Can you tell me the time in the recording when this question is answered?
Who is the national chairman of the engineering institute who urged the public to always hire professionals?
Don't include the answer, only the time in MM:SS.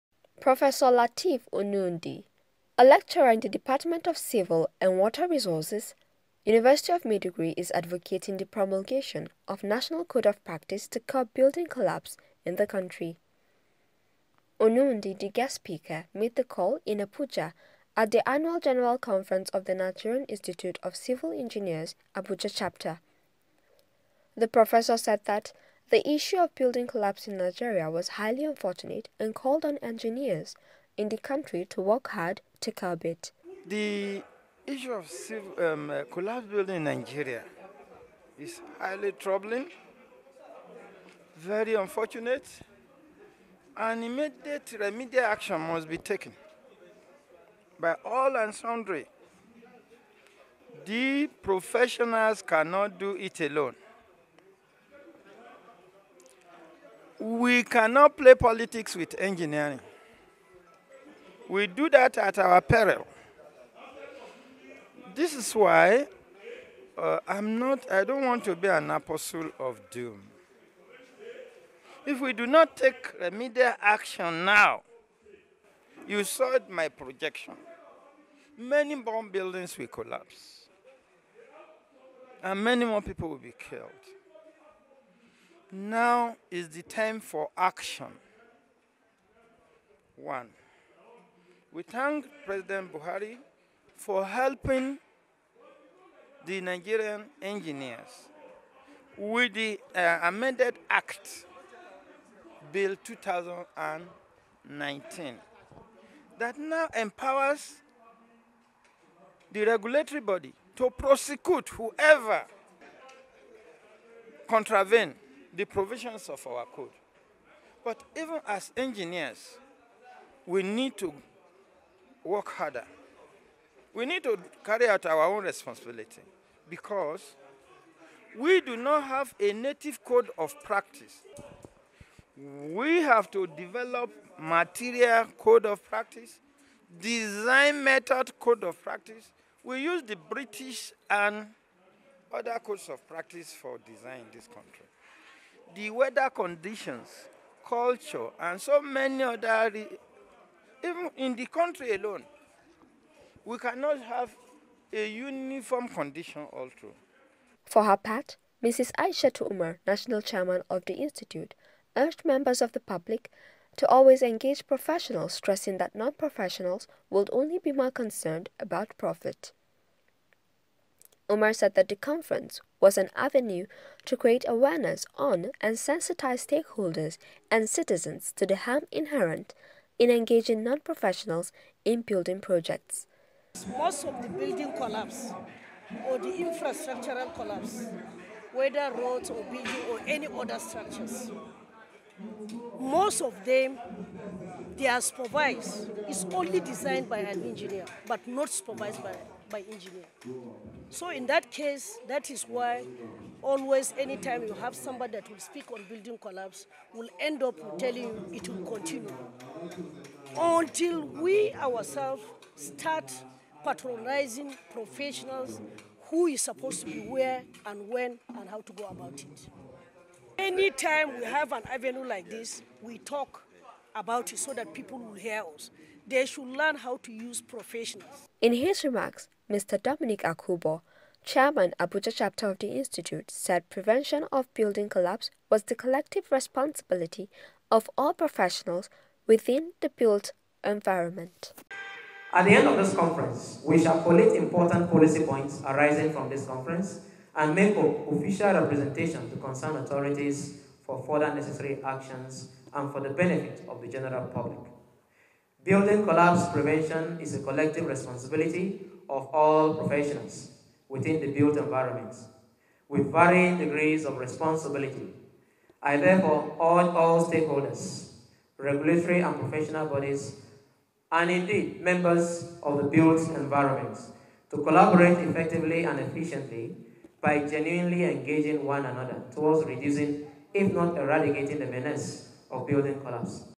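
02:38.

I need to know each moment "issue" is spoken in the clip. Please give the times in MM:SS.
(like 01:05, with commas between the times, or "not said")
00:26, 00:34.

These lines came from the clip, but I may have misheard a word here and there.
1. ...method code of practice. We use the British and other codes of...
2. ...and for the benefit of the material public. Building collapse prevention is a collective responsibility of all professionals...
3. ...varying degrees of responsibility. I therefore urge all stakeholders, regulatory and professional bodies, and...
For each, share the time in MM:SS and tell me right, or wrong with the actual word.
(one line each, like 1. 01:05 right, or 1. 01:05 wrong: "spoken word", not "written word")
1. 02:17 right
2. 04:12 wrong: "general", not "material"
3. 04:23 right.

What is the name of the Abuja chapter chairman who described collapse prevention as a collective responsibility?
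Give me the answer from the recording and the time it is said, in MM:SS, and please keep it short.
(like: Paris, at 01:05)
Dominic Akuboh, at 03:49.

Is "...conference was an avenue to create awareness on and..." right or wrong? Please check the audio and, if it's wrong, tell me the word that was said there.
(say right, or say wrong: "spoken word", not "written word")
right.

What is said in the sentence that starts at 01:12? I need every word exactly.
If we do not take remedial action now, you saw my projection.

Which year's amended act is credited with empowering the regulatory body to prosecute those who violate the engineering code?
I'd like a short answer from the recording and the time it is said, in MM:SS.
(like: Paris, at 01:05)
2019, at 01:42.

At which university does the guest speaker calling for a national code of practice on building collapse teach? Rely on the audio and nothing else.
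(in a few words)
University of Maiduguri.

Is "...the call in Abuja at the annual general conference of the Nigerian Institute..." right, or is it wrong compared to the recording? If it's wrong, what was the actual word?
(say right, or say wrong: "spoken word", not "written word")
right.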